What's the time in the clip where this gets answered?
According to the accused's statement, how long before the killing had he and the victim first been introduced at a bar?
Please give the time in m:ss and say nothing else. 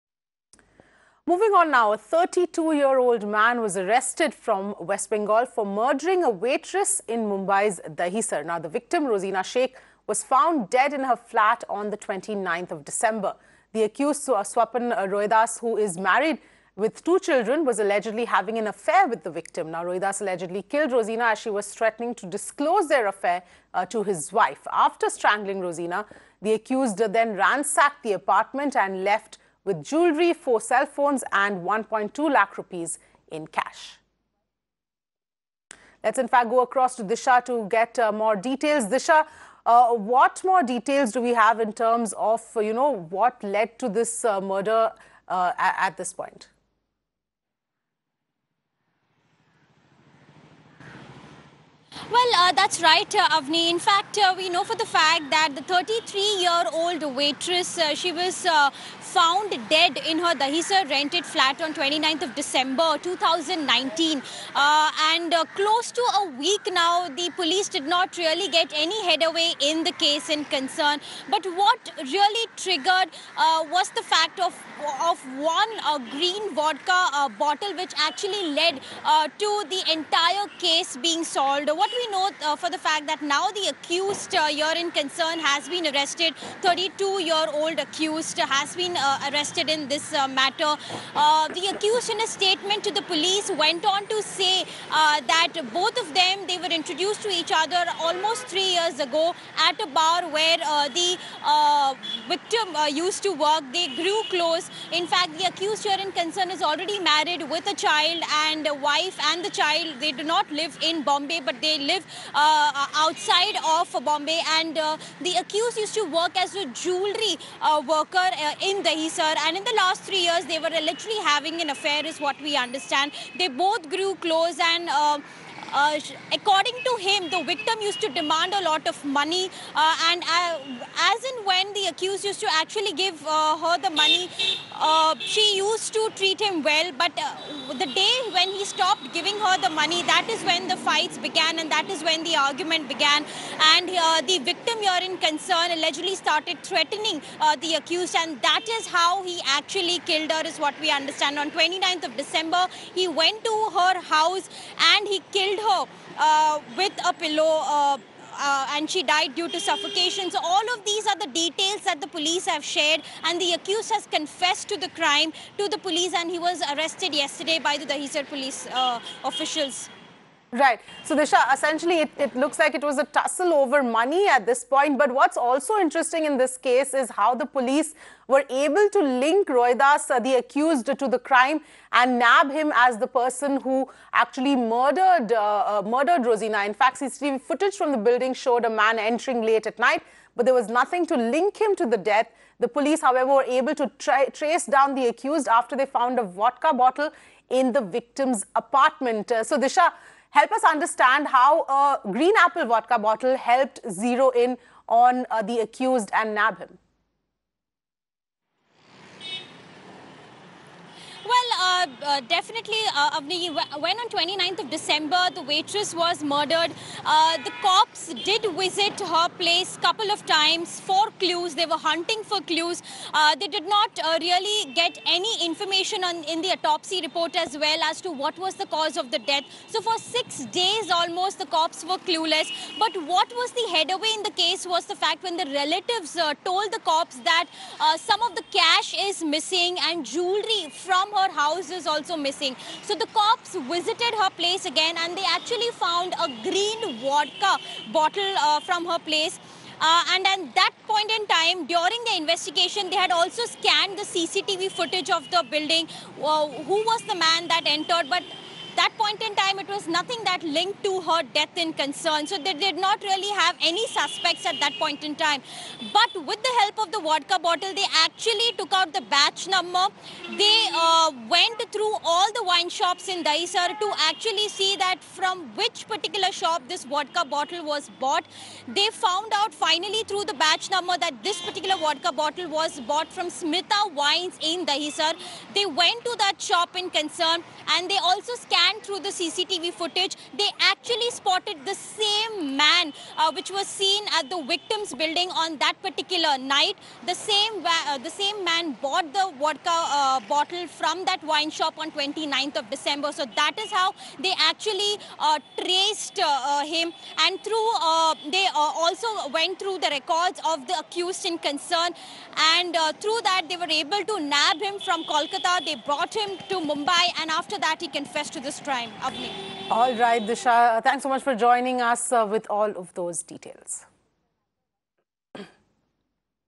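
1:38.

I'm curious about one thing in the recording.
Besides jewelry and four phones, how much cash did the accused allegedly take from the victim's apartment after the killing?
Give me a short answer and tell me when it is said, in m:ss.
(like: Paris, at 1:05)
1.2 lakh rupees, at 0:31.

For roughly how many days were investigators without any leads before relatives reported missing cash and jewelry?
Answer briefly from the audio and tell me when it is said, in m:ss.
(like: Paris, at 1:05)
6 days, at 3:49.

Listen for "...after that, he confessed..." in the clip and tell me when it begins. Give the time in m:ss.
5:17.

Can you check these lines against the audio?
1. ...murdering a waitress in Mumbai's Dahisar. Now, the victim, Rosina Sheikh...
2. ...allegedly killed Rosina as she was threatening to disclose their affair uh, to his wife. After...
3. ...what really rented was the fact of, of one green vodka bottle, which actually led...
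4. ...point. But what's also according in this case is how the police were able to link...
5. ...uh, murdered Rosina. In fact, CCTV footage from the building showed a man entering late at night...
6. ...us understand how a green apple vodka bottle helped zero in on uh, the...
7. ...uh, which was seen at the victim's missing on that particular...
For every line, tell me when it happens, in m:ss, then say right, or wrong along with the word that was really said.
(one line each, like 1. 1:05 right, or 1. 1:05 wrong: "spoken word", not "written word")
1. 0:05 right
2. 0:20 right
3. 1:11 wrong: "triggered", not "rented"
4. 2:54 wrong: "interesting", not "according"
5. 3:05 right
6. 3:20 right
7. 4:53 wrong: "building", not "missing".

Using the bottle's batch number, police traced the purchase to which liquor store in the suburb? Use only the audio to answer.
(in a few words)
Smita Wines.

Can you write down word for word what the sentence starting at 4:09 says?
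Uh, and at that point in time, during the investigation, they had also scanned the CCTV footage of the building.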